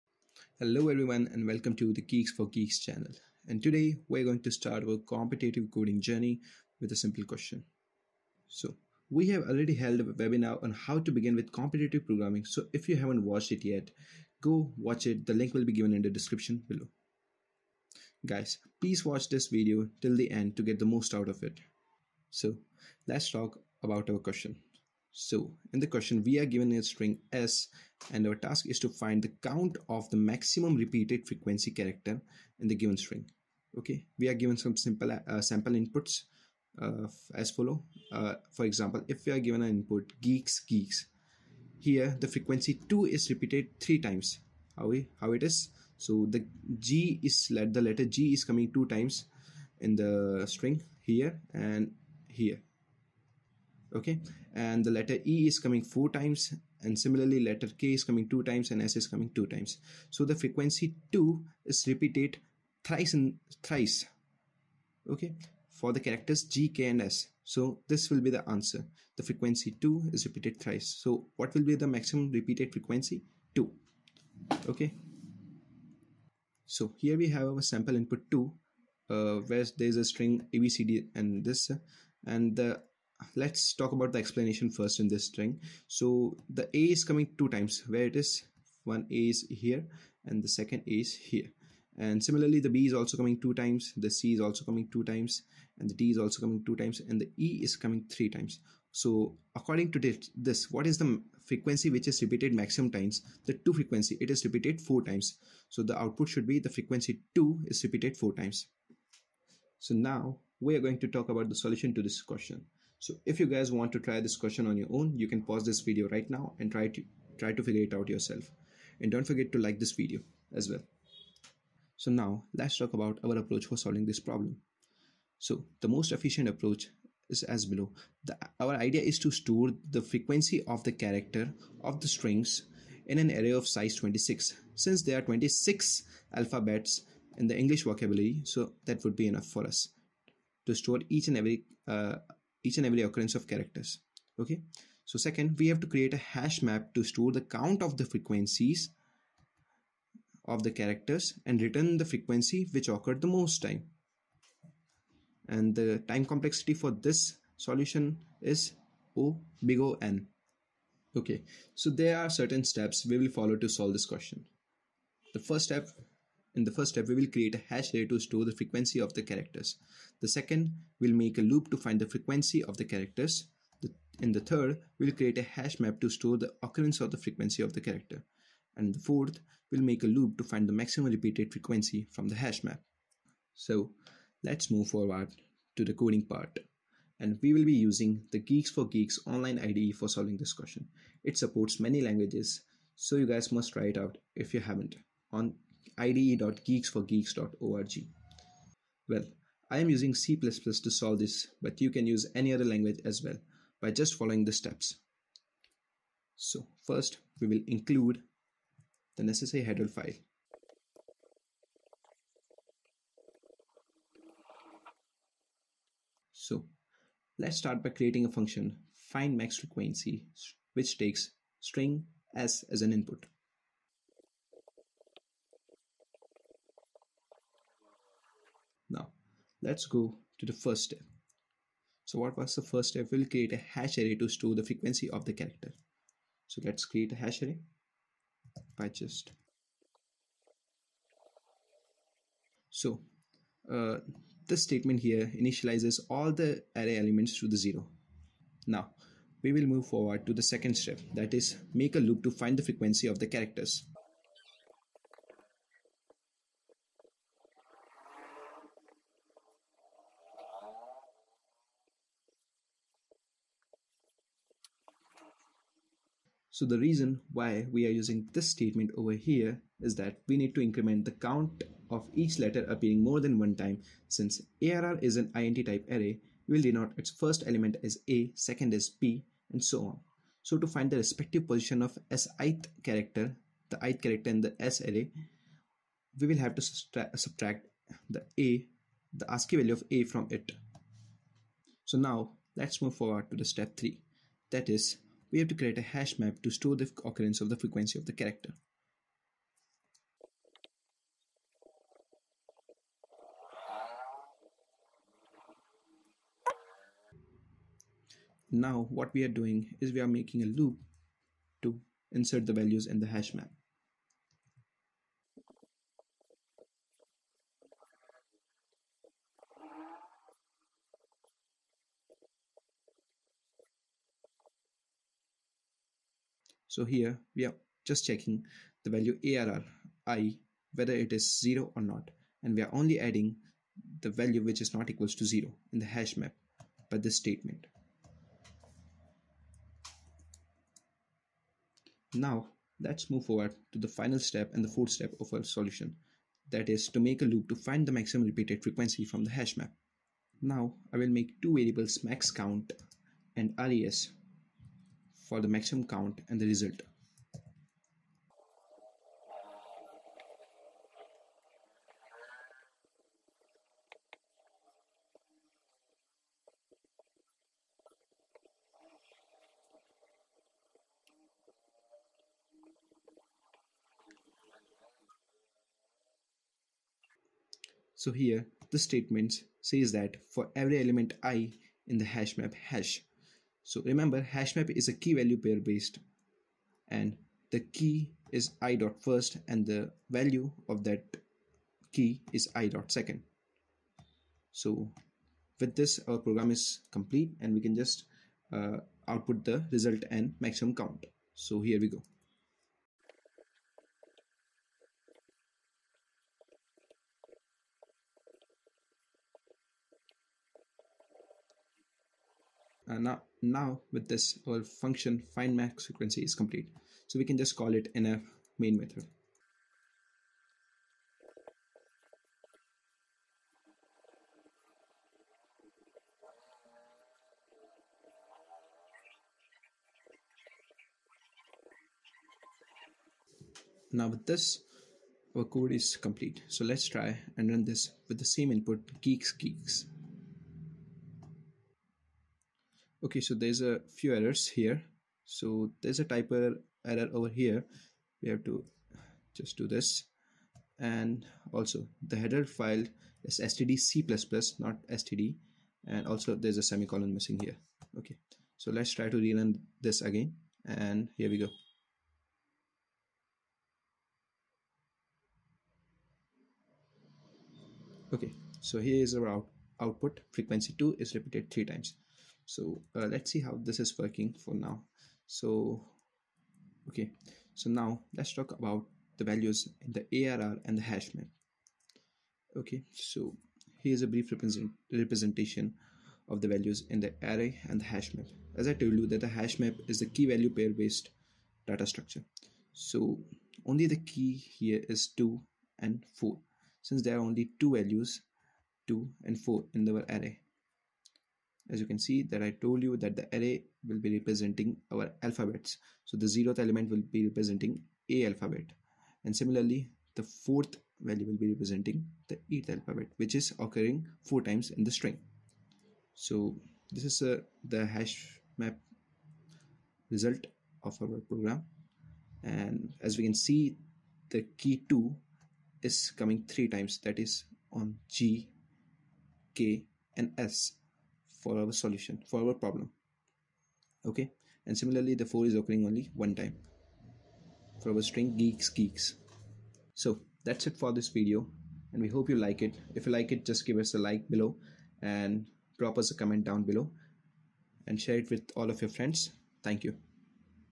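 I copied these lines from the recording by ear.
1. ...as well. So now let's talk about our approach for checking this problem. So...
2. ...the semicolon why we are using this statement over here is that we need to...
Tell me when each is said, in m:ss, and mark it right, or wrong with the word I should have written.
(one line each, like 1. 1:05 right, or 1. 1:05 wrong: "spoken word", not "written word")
1. 2:00 wrong: "solving", not "checking"
2. 4:26 wrong: "reason", not "semicolon".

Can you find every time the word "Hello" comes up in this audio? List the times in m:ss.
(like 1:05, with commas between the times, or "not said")
0:00.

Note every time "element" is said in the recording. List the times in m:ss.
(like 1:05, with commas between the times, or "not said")
4:06, 4:37, 6:20, 8:26.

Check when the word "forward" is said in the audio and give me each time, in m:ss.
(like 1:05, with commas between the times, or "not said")
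3:04, 4:09, 4:52, 5:43.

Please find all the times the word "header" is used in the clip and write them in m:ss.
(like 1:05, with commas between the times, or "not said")
3:29, 7:32.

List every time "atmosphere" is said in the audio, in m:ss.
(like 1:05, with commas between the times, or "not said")
not said.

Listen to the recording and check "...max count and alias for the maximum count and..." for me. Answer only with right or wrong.
right.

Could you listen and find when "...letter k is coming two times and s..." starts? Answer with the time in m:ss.
0:57.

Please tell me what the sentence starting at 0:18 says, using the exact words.
Guys, please watch this video till the end to get the most out of it.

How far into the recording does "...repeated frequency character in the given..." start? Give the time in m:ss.
0:30.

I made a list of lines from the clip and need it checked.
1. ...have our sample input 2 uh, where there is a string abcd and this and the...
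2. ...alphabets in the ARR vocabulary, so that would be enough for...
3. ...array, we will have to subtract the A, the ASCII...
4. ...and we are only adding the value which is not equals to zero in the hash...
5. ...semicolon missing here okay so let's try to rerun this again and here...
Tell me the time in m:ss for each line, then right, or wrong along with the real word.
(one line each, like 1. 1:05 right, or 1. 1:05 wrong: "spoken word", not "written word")
1. 1:17 right
2. 2:16 wrong: "English", not "ARR"
3. 4:44 right
4. 5:32 right
5. 7:36 right.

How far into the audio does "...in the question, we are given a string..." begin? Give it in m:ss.
0:25.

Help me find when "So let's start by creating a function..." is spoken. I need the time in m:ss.
3:36.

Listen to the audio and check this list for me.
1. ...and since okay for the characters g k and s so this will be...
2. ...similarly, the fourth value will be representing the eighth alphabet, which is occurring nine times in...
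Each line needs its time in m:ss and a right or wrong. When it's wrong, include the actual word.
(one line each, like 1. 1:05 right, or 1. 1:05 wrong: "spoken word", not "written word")
1. 1:03 wrong: "thrice", not "since"
2. 8:29 wrong: "four", not "nine".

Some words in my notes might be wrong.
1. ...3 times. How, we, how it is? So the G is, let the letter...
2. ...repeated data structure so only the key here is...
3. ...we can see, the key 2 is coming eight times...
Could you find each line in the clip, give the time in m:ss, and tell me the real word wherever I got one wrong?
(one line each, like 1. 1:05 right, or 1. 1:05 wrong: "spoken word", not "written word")
1. 0:43 right
2. 8:10 wrong: "based", not "repeated"
3. 8:43 wrong: "three", not "eight".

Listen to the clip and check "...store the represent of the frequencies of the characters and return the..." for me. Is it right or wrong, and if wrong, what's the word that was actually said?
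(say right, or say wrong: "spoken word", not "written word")
wrong: "count", not "represent".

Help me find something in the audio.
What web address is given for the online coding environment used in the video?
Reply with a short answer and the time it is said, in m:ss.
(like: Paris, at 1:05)
ide.geeksforgeeks.org, at 3:15.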